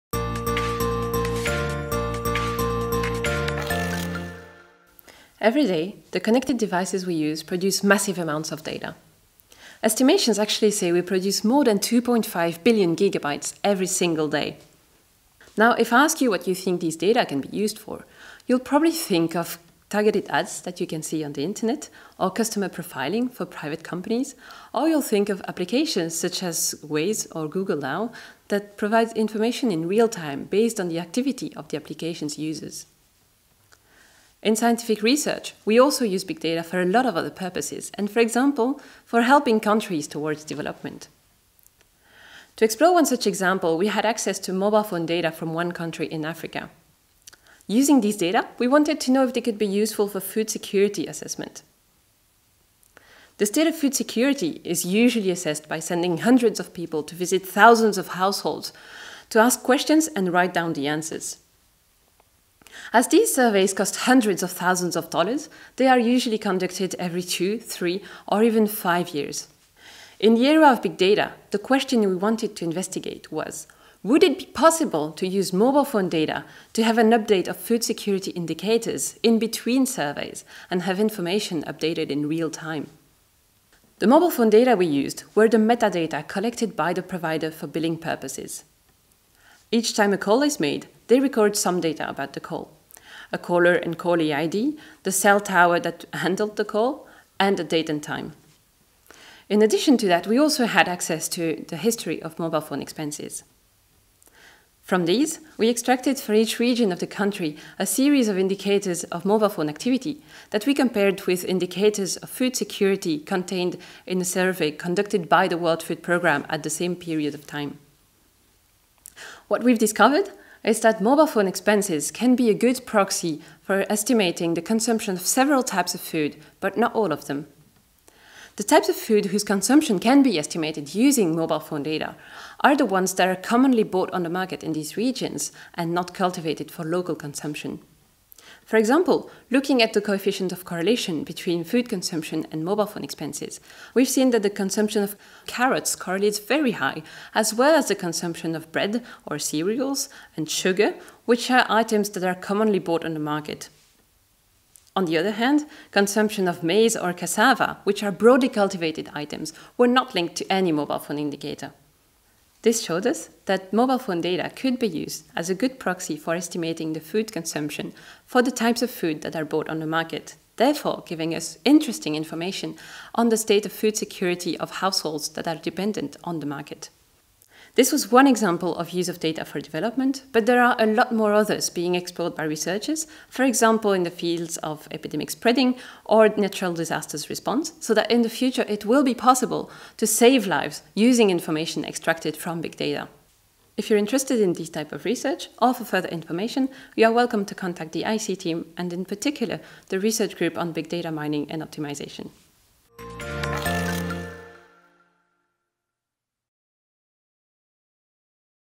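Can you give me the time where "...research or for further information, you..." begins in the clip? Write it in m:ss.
3:15.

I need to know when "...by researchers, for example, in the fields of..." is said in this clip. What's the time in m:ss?
3:02.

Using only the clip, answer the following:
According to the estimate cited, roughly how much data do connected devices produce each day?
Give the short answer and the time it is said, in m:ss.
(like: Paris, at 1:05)
2.5 billion gigabytes, at 0:11.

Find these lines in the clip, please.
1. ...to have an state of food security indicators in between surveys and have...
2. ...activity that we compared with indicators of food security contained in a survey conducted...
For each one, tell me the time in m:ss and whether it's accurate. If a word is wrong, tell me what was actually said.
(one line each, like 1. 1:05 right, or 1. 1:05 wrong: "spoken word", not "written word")
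1. 1:16 wrong: "update", not "state"
2. 1:49 right.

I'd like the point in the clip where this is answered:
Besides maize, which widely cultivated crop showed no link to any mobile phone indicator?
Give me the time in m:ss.
2:37.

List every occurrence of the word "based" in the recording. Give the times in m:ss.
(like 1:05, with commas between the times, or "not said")
0:30.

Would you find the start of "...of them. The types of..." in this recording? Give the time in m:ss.
2:07.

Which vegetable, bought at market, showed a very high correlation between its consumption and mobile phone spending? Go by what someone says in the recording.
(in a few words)
carrots.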